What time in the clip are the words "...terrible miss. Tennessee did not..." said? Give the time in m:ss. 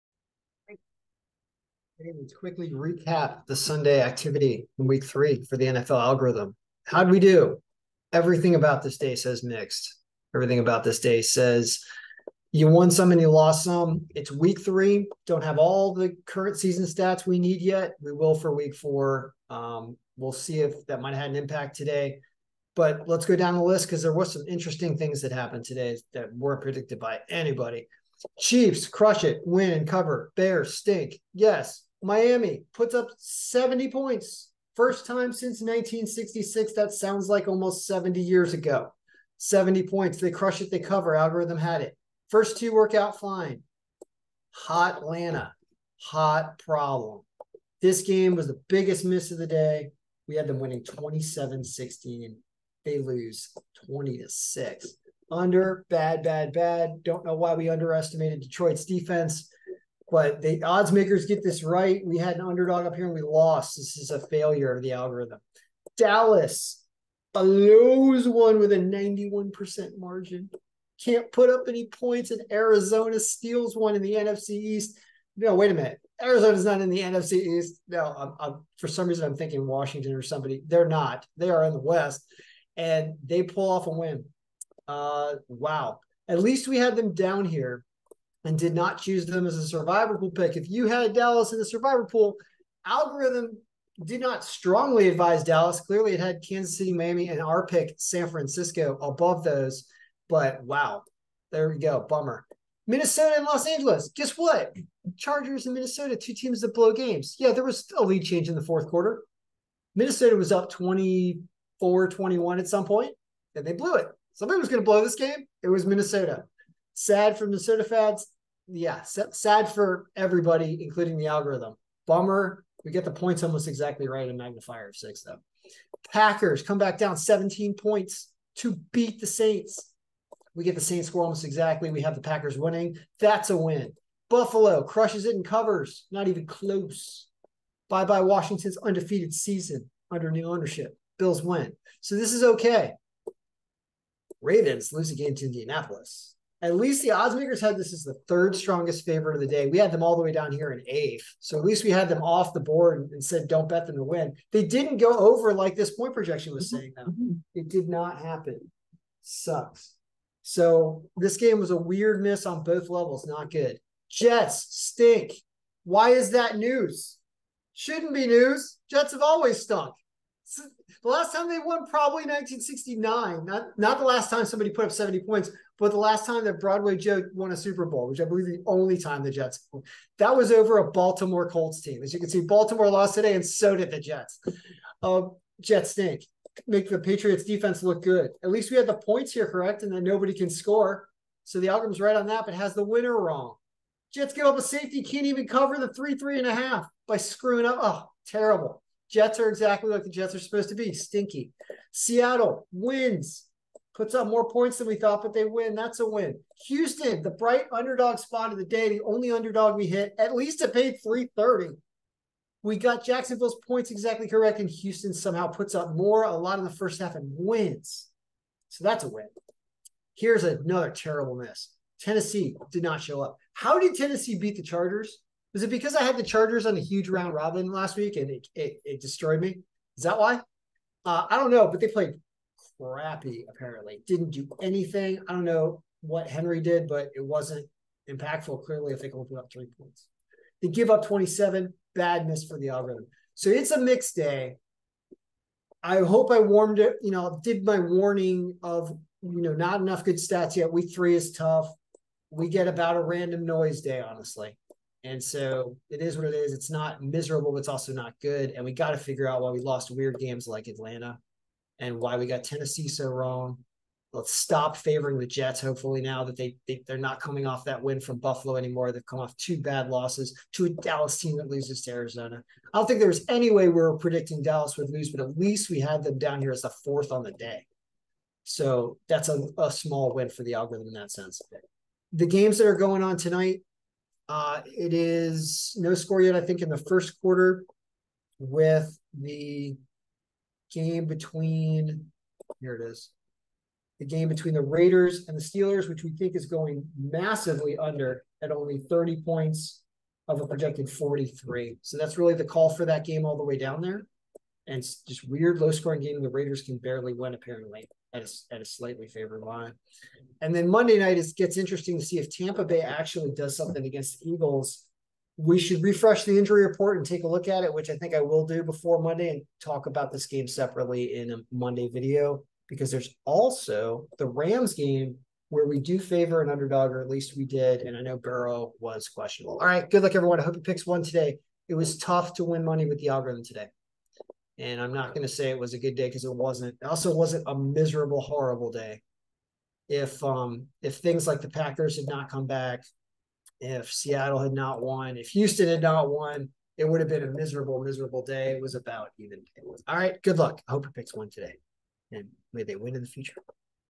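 3:40.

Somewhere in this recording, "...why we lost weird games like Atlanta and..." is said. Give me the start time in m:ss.
4:19.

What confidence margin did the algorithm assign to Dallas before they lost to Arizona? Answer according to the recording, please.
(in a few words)
91%.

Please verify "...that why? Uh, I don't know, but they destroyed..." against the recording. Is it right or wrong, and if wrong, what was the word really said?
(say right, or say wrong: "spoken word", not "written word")
wrong: "played", not "destroyed".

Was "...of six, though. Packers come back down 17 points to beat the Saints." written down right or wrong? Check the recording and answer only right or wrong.
right.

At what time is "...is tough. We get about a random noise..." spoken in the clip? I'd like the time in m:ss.
4:11.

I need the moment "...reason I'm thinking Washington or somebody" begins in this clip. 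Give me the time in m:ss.
1:19.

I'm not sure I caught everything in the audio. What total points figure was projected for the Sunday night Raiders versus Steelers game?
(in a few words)
43.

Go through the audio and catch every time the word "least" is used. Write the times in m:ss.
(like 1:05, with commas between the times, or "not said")
1:26, 2:26, 2:31, 3:08, 3:30, 4:35, 5:27.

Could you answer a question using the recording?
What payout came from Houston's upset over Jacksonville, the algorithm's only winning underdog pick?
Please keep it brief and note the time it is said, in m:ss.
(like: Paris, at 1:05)
330, at 3:31.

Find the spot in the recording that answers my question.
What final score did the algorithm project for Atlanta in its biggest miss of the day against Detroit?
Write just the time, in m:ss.
0:50.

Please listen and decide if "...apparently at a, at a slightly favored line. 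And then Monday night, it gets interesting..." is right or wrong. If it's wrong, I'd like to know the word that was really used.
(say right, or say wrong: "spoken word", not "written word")
right.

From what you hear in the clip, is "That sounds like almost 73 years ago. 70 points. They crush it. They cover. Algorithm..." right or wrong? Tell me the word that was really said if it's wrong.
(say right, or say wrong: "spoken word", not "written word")
wrong: "70", not "73".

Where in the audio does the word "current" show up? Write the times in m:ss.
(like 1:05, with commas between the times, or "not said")
0:16.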